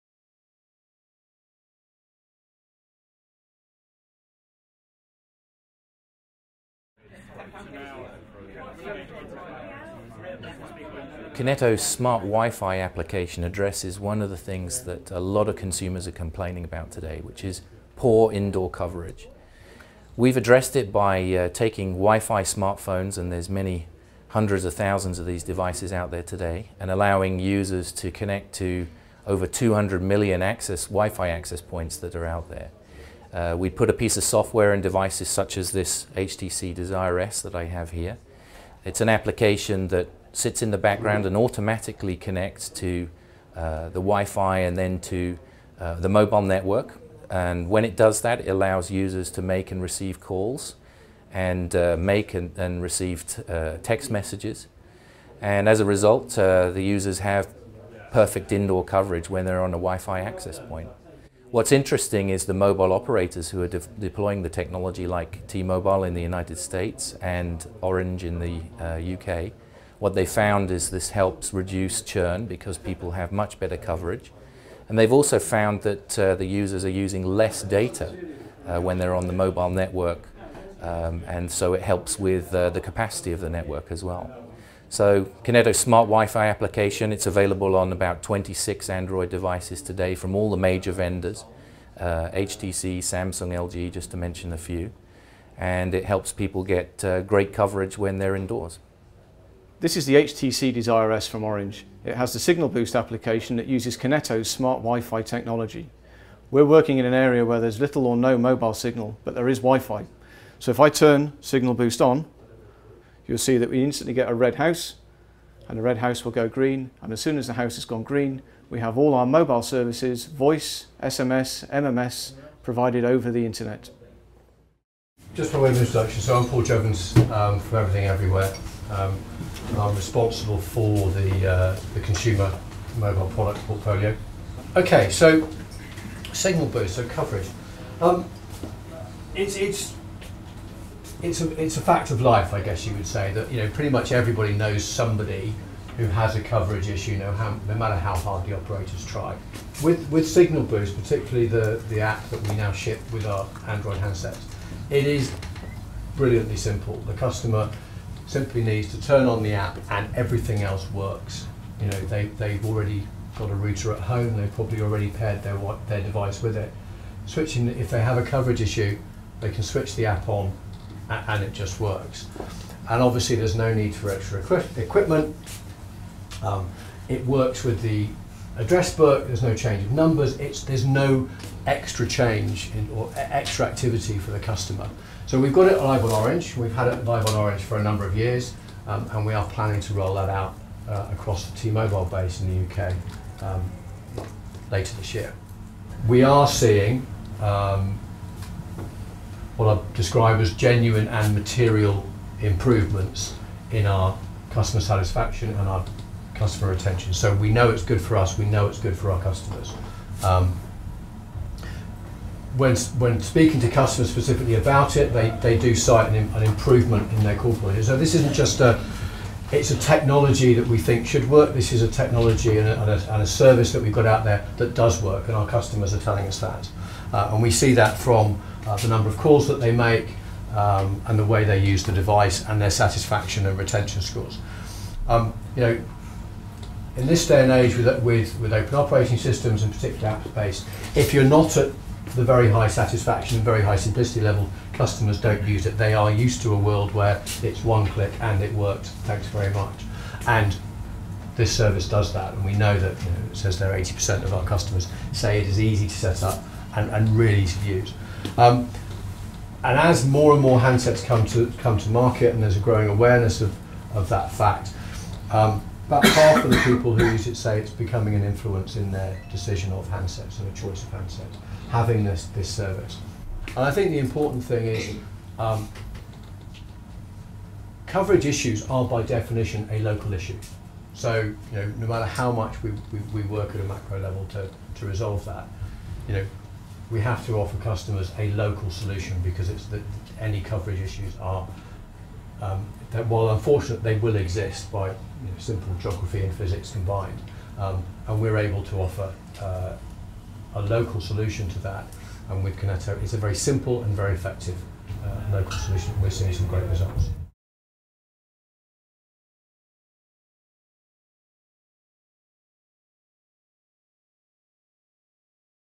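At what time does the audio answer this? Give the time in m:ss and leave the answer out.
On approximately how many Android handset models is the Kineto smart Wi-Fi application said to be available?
1:28.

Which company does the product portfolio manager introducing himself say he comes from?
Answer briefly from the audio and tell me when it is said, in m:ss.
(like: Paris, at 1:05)
Everything Everywhere, at 2:07.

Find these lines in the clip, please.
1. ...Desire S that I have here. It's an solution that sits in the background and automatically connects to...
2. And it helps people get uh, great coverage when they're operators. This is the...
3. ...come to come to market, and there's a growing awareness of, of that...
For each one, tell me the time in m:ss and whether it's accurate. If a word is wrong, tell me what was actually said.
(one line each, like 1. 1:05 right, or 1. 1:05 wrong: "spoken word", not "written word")
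1. 0:36 wrong: "application", not "solution"
2. 1:35 wrong: "indoors", not "operators"
3. 4:21 right.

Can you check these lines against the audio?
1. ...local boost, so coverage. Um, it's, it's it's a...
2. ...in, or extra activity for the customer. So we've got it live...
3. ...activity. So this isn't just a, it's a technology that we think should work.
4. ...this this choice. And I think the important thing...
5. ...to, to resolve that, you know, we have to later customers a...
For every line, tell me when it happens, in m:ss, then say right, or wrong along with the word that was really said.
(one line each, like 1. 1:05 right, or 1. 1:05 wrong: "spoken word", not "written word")
1. 2:16 wrong: "signal", not "local"
2. 3:02 right
3. 3:37 wrong: "quality", not "activity"
4. 4:32 wrong: "service", not "choice"
5. 4:44 wrong: "offer", not "later".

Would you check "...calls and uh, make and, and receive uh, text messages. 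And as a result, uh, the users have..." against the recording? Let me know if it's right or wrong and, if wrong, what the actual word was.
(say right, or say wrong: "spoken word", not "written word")
right.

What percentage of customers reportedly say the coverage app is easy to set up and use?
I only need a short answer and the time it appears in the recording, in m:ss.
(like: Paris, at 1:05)
80%, at 4:13.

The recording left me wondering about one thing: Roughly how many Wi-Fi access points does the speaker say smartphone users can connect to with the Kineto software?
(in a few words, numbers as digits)
200 million.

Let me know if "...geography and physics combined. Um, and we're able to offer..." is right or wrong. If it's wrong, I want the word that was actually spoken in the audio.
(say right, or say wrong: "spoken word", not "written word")
right.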